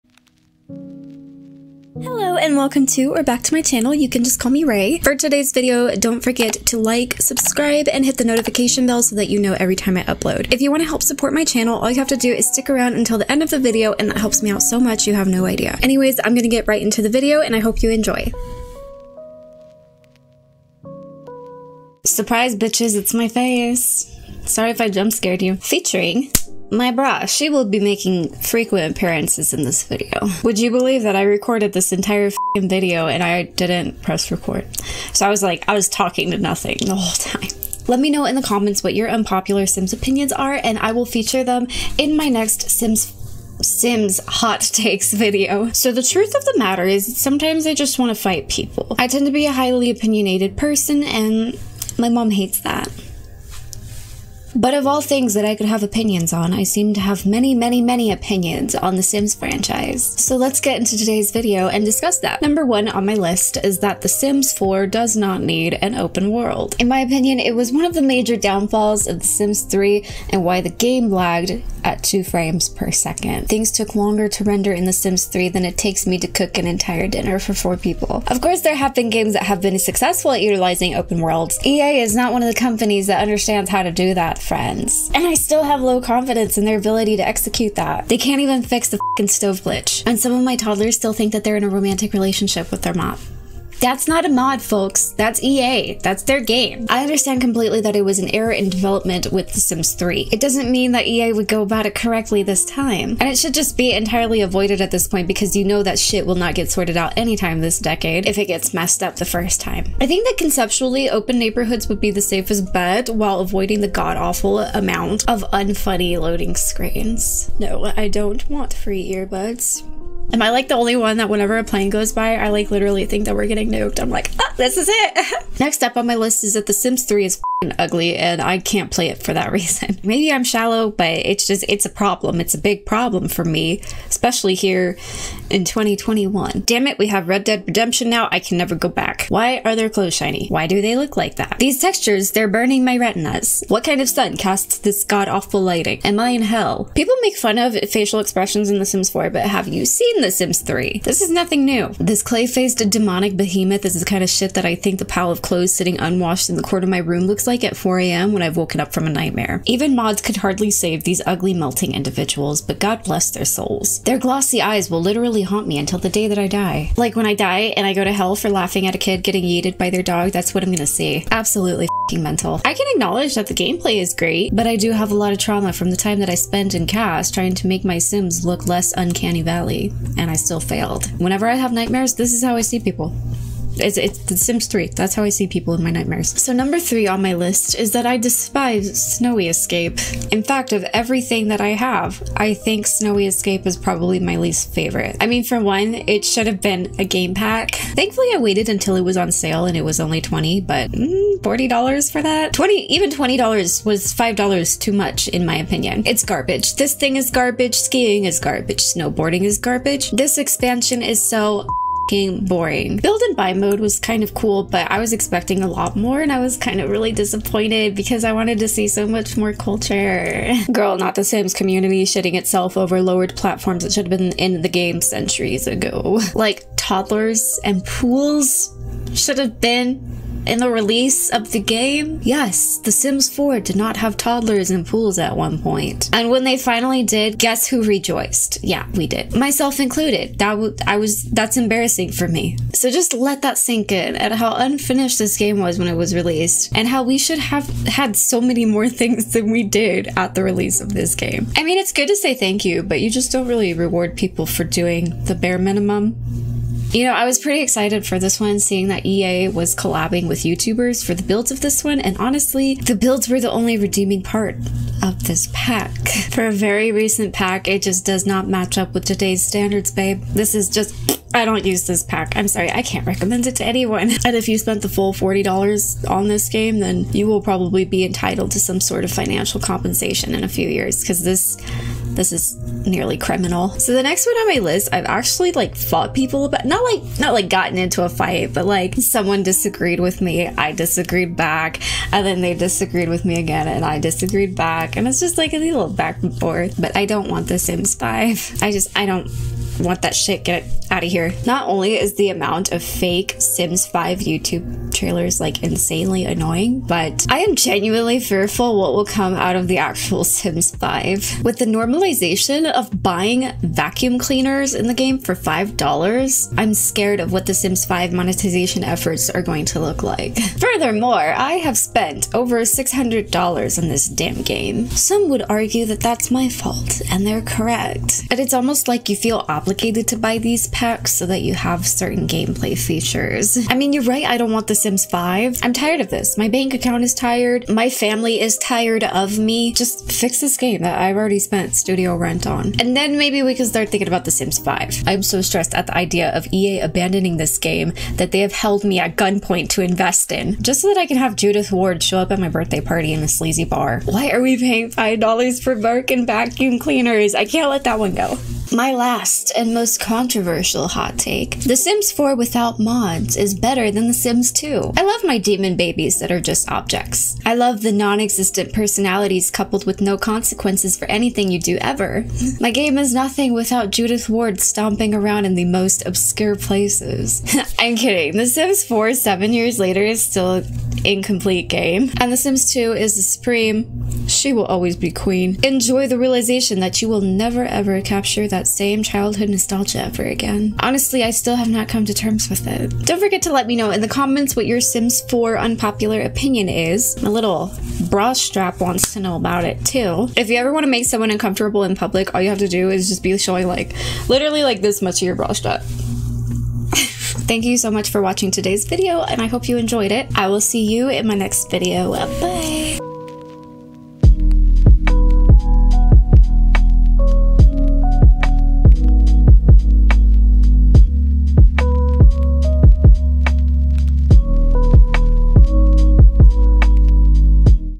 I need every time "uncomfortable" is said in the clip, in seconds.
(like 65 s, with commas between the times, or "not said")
401 s.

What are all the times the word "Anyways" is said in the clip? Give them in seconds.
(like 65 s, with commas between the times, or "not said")
15 s.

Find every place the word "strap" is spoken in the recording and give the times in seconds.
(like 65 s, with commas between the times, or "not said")
398 s, 405 s.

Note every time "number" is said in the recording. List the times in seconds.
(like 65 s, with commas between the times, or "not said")
62 s, 186 s.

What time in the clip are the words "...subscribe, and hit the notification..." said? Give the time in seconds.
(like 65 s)
7 s.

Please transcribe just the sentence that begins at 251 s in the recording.
I mean, it's good to say thank you, but you just don't really reward people for doing the bare minimum.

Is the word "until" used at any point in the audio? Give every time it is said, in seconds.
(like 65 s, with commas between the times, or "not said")
12 s, 165 s, 198 s.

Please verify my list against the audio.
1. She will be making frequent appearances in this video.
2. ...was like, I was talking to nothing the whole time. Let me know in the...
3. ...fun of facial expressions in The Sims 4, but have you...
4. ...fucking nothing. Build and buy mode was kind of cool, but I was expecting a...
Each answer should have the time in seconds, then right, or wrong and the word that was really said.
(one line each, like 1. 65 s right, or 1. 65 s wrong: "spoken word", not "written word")
1. 27 s right
2. 35 s right
3. 147 s right
4. 212 s wrong: "boring", not "nothing".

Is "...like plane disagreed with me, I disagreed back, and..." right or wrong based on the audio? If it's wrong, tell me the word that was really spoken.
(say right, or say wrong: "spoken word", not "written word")
wrong: "someone", not "plane".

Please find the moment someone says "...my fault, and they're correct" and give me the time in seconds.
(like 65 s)
326 s.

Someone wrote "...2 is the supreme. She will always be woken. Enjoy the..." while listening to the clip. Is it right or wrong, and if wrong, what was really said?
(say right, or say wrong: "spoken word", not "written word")
wrong: "queen", not "woken".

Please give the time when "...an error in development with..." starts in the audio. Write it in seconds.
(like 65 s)
98 s.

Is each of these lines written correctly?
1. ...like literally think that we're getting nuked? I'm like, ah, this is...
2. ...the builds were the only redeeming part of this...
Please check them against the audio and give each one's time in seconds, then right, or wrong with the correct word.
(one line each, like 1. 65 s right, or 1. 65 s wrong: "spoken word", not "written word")
1. 122 s right
2. 262 s right.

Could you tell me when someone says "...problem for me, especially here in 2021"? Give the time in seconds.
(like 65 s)
132 s.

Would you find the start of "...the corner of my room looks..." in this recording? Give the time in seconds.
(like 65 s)
156 s.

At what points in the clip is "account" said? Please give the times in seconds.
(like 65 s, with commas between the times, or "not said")
336 s.